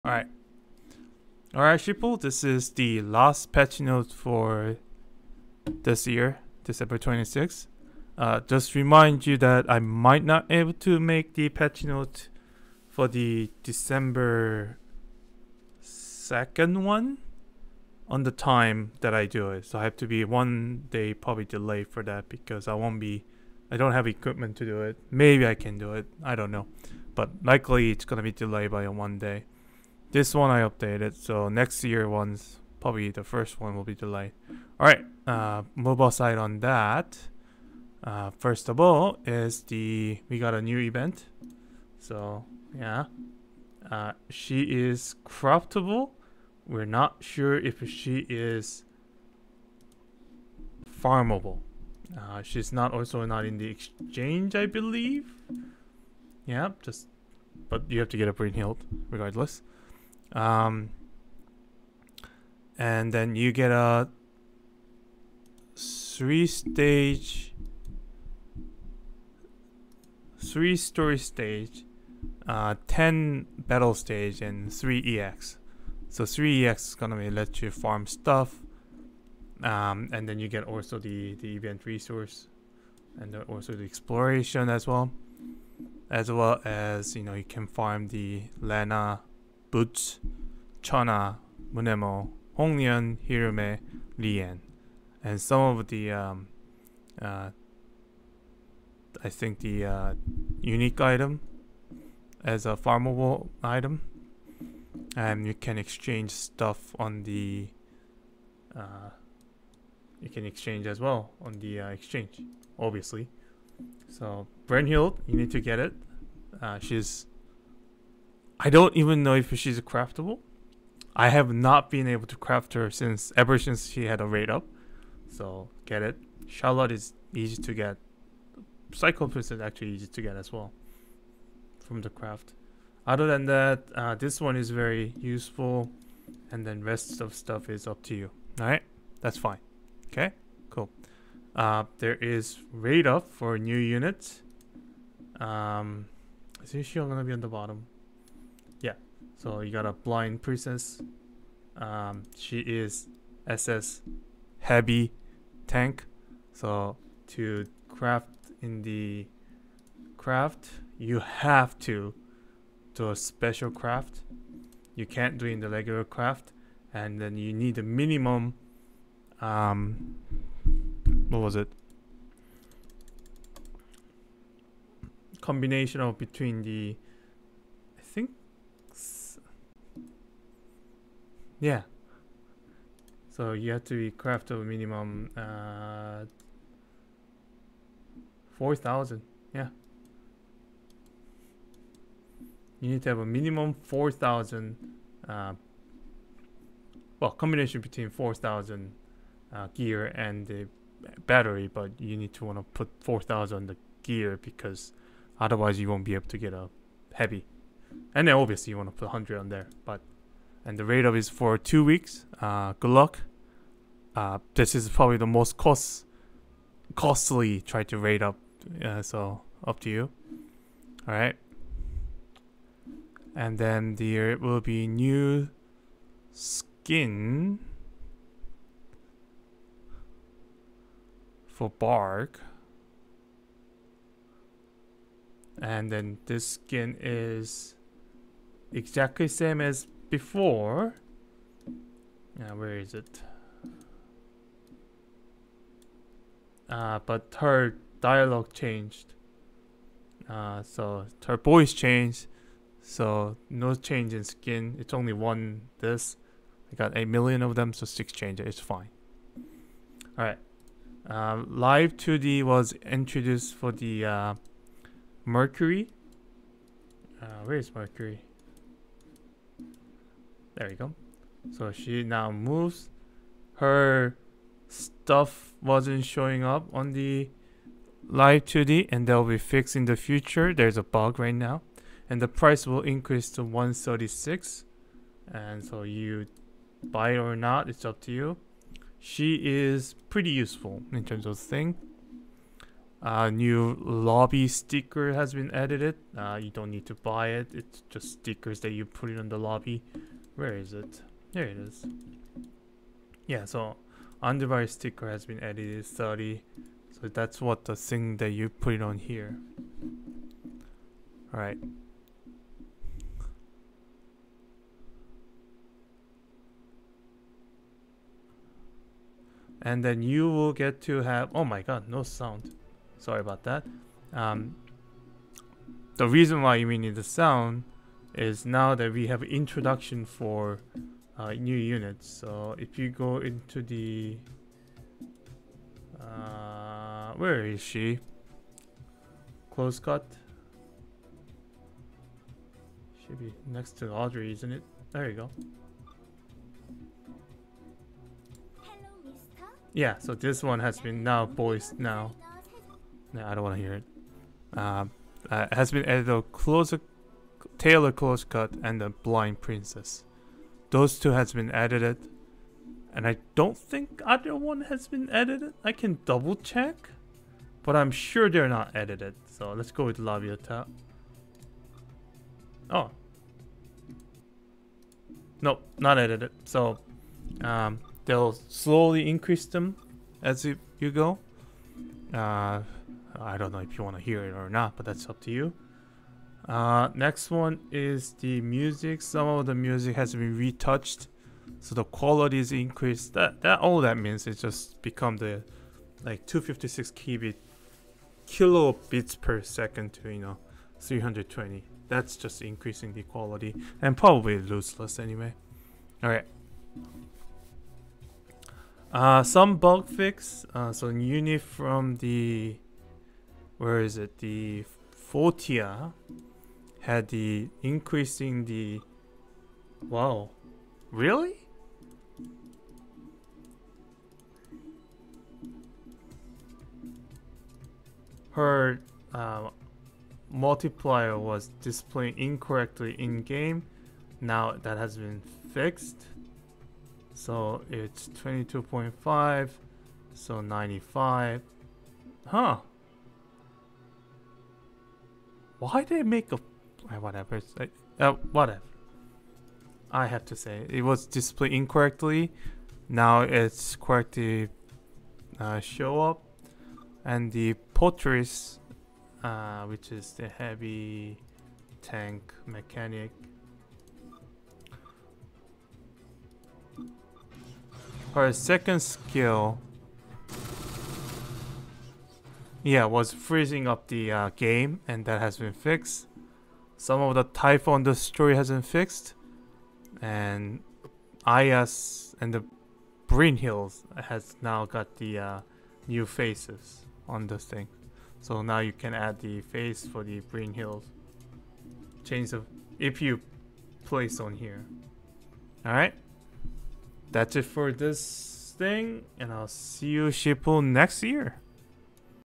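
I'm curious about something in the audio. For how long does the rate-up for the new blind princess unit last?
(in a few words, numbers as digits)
two weeks.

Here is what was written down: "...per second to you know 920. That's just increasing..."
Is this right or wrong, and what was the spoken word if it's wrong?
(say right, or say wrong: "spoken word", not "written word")
wrong: "320", not "920".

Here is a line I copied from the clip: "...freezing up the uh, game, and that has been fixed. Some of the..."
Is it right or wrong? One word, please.
right.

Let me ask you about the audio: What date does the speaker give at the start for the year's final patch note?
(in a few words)
December 26th.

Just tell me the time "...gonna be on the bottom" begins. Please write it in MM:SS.
02:26.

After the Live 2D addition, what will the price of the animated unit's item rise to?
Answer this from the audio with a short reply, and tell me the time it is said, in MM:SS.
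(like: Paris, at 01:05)
136, at 04:43.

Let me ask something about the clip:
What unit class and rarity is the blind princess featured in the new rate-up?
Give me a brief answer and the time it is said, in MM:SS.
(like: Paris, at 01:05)
SS heavy tank, at 02:33.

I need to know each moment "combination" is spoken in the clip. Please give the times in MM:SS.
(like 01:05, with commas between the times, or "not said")
02:55, 03:17.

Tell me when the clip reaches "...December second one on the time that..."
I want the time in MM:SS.
00:13.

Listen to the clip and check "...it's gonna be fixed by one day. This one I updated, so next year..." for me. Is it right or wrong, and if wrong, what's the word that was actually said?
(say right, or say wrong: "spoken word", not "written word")
wrong: "delayed", not "fixed".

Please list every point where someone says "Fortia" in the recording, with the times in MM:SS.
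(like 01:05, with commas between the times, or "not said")
06:55.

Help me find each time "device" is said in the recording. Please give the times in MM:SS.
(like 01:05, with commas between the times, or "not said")
05:04.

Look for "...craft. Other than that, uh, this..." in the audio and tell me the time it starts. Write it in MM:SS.
02:12.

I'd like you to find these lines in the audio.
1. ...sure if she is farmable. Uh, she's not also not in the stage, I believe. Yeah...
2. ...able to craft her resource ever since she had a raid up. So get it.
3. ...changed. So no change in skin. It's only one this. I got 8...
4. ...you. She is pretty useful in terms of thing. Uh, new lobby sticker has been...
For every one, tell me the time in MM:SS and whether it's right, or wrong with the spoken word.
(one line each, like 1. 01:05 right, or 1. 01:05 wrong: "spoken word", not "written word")
1. 00:47 wrong: "exchange", not "stage"
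2. 02:02 wrong: "since", not "resource"
3. 04:11 right
4. 04:48 right.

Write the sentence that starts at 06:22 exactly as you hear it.
Uh, I don't know if you want to hear it or not, but that's up to you.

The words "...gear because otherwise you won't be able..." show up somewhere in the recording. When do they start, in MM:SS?
03:24.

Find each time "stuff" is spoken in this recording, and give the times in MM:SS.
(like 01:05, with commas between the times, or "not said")
01:18, 01:46, 02:17, 04:34.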